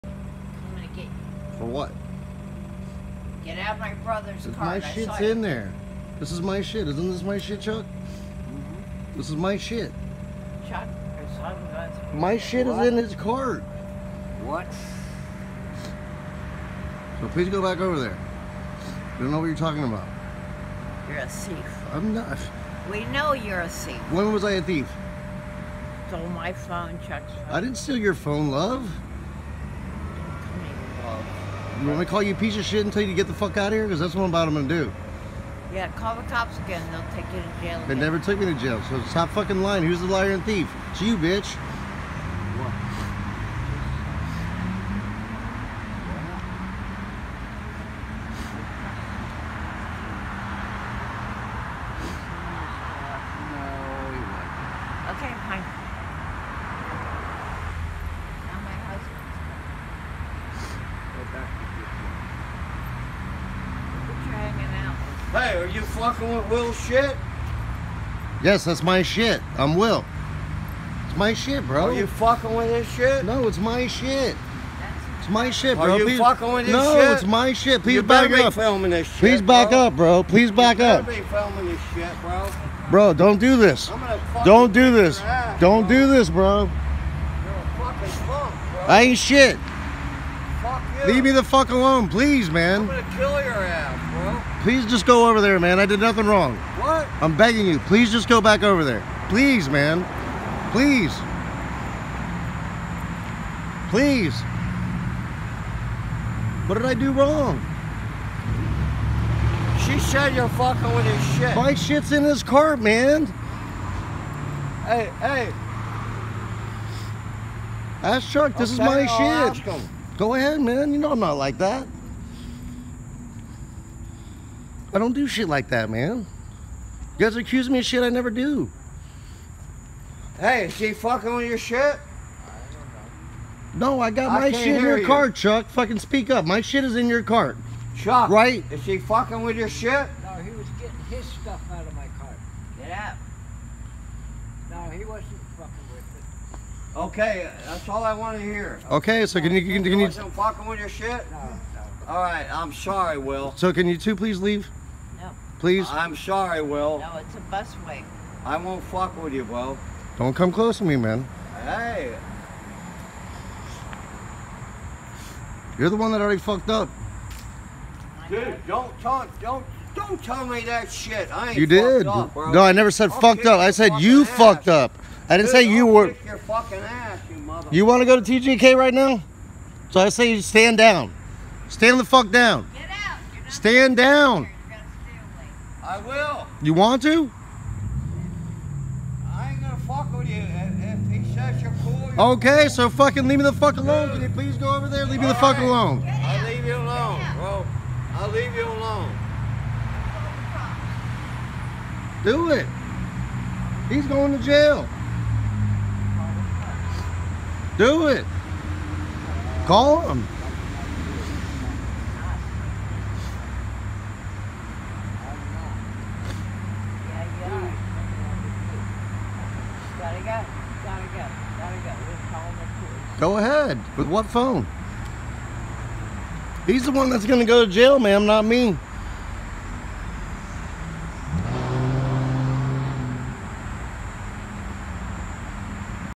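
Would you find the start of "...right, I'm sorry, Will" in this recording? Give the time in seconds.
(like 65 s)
152 s.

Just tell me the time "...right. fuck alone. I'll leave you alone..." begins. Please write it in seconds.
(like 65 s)
195 s.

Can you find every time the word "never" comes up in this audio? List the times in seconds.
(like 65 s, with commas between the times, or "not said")
37 s, 128 s, 172 s.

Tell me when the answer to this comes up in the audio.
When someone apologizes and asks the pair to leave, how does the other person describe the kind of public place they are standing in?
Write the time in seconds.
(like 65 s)
157 s.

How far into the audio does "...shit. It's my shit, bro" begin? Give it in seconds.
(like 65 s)
73 s.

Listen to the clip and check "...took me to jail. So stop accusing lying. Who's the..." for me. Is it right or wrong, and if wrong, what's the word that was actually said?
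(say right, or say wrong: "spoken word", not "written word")
wrong: "fucking", not "accusing".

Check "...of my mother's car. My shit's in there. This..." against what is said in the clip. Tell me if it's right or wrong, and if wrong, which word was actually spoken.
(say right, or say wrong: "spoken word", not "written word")
wrong: "brother", not "mother".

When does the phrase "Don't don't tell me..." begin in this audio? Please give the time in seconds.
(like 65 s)
169 s.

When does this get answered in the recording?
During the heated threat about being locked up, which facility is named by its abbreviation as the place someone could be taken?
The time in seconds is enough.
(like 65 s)
178 s.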